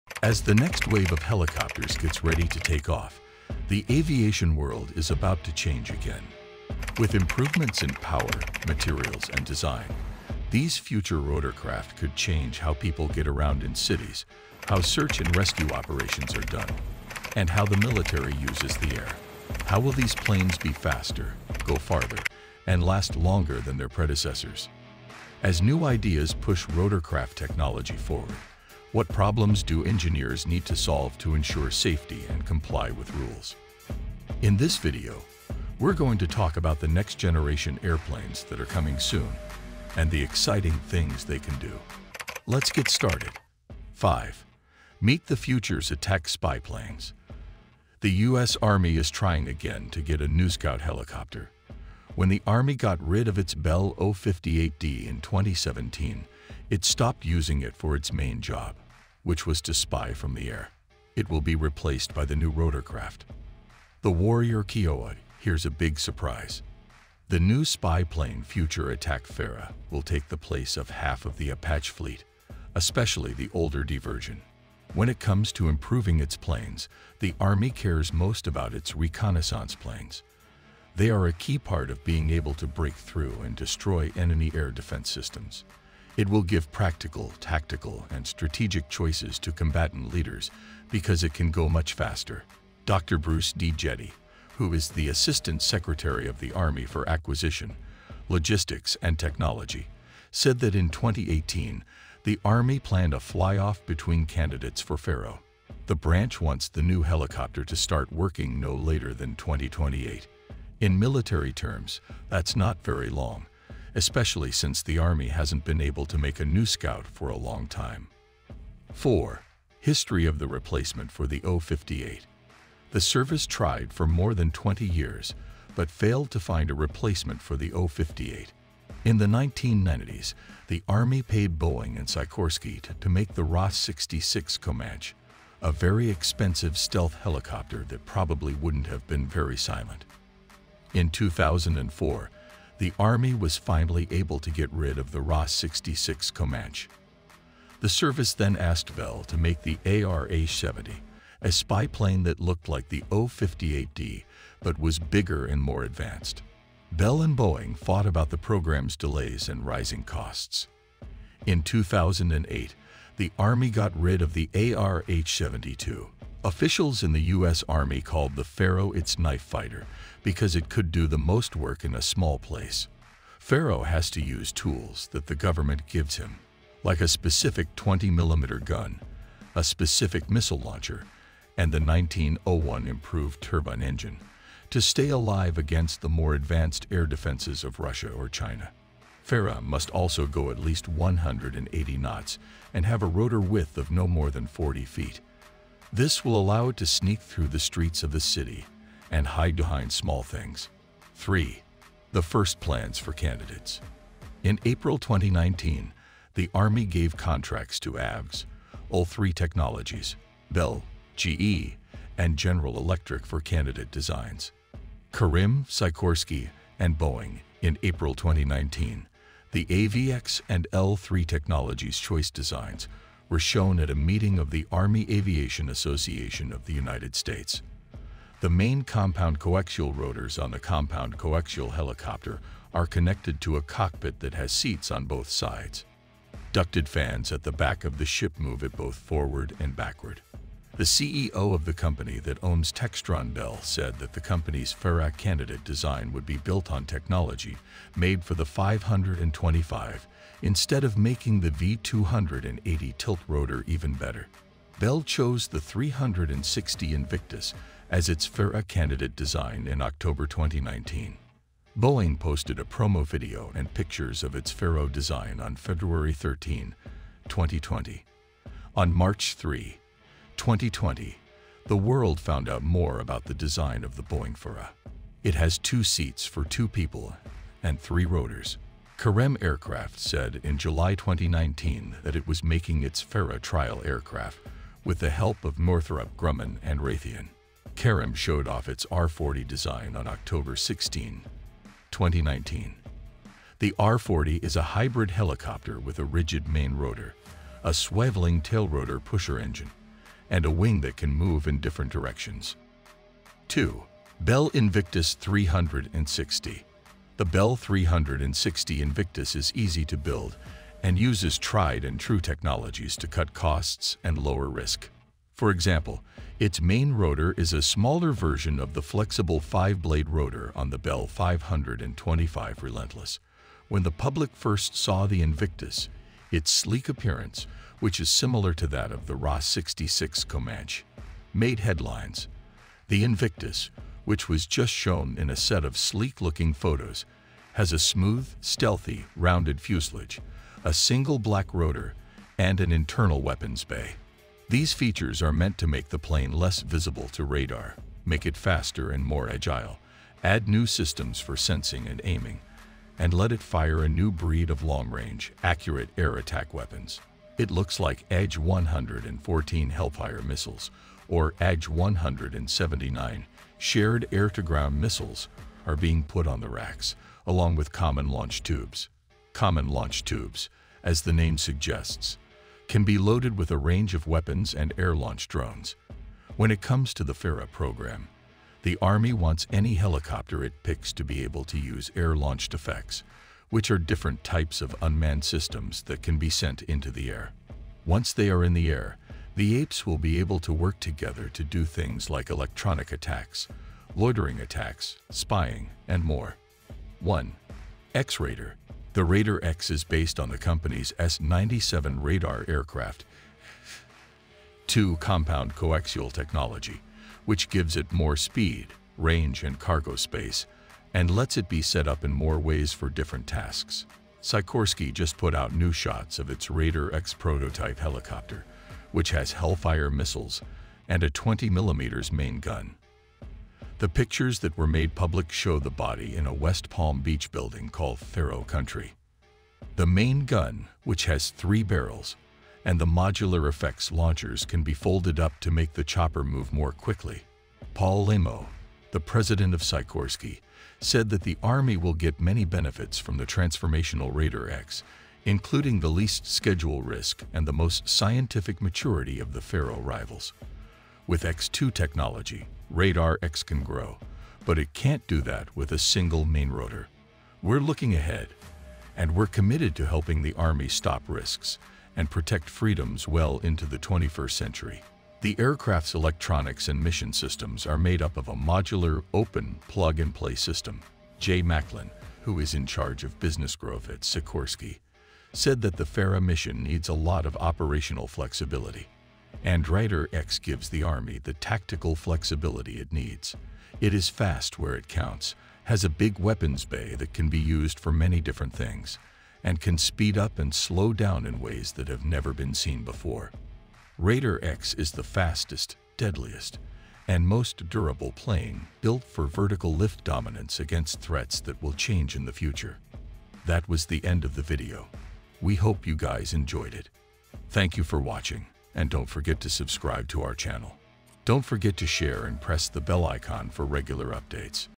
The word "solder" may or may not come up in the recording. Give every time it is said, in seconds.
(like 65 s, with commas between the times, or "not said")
not said.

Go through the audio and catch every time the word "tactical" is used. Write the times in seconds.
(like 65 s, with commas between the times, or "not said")
87 s, 481 s.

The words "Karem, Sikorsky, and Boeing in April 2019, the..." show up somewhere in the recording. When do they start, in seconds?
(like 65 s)
215 s.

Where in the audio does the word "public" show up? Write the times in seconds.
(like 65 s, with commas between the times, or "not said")
323 s, 424 s.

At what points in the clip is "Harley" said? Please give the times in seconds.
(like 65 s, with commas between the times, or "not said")
not said.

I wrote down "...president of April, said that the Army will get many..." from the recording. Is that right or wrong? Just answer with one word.
wrong.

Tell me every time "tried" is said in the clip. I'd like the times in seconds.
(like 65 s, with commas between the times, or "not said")
123 s, 311 s.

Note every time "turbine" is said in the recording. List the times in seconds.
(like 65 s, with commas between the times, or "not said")
183 s.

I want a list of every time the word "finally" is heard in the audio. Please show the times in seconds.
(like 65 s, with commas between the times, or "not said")
143 s.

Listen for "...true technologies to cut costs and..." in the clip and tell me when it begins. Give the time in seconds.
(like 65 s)
311 s.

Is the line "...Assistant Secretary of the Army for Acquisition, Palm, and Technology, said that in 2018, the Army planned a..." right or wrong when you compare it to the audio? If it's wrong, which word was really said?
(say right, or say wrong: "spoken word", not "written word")
wrong: "Logistics", not "Palm".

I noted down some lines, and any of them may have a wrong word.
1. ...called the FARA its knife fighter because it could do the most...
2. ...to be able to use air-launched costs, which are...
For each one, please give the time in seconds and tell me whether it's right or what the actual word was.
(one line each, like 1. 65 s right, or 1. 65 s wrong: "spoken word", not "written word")
1. 168 s right
2. 380 s wrong: "effects", not "costs".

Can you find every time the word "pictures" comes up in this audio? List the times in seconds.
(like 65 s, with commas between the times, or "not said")
263 s, 423 s.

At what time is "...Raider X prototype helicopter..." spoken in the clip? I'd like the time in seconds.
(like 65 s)
416 s.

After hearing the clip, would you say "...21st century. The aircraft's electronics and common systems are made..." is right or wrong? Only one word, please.
wrong.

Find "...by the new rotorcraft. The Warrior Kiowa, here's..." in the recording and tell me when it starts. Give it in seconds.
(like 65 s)
62 s.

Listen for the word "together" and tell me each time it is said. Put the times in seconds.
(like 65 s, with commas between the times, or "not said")
390 s.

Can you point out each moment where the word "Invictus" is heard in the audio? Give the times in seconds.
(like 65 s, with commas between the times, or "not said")
256 s, 304 s, 308 s, 325 s, 333 s.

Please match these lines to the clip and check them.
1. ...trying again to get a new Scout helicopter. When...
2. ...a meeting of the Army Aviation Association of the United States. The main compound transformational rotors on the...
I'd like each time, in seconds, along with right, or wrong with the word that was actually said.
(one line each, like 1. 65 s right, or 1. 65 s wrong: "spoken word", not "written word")
1. 49 s right
2. 223 s wrong: "coaxial", not "transformational".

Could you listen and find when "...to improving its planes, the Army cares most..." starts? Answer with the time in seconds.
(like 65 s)
75 s.